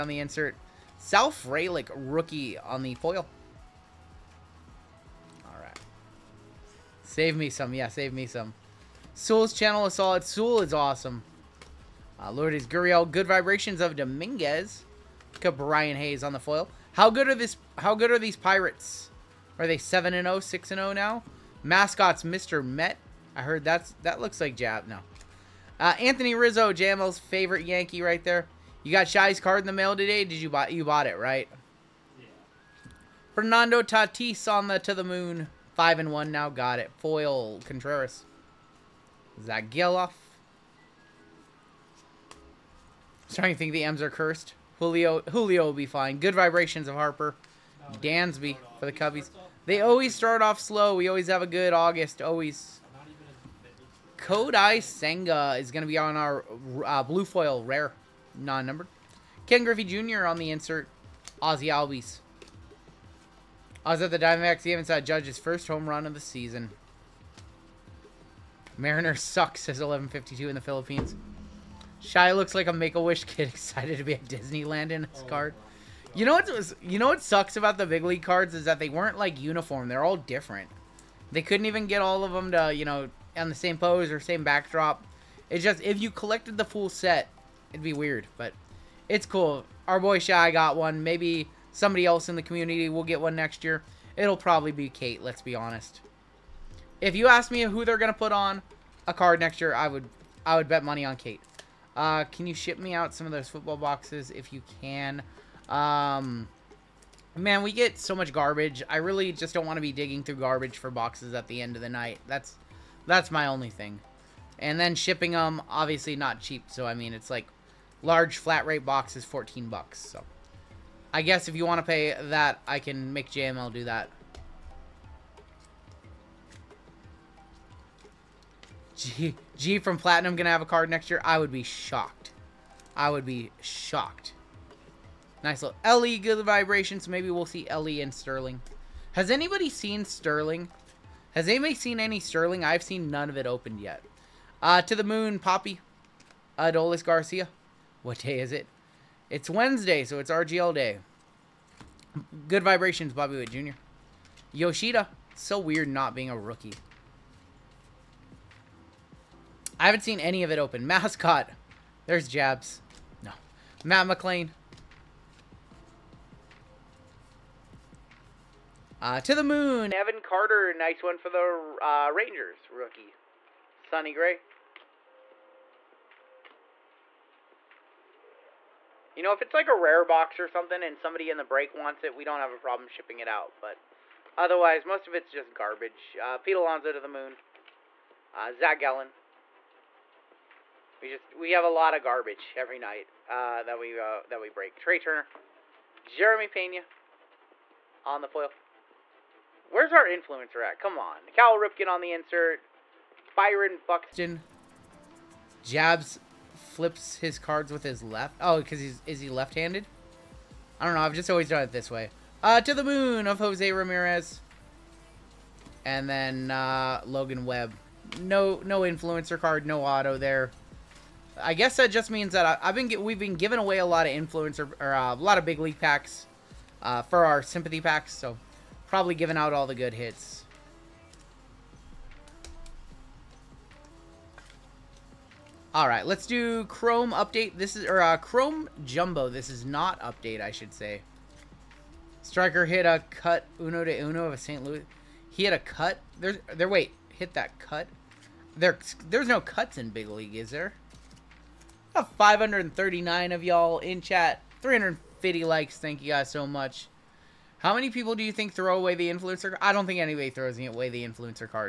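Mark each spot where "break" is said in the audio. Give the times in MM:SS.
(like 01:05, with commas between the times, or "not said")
03:01, 03:14.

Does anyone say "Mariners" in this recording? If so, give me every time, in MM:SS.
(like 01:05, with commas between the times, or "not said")
01:08.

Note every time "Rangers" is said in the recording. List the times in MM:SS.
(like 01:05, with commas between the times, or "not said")
02:52.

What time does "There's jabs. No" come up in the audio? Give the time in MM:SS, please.
02:42.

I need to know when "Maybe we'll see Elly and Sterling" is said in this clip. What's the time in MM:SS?
02:17.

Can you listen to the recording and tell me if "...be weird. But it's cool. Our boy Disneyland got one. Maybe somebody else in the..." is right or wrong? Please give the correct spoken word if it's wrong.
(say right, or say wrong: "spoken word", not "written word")
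wrong: "Shy", not "Disneyland".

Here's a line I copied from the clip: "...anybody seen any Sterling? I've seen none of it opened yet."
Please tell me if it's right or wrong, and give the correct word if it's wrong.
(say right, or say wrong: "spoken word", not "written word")
right.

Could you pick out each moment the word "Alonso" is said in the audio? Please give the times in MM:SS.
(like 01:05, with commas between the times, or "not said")
03:06.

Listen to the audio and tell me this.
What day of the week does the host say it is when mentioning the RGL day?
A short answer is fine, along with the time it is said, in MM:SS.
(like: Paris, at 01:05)
Wednesday, at 02:29.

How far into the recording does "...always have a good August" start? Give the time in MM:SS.
00:51.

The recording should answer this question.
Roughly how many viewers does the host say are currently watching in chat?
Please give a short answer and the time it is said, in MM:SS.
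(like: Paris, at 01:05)
539, at 04:12.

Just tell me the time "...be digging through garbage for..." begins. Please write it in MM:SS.
01:49.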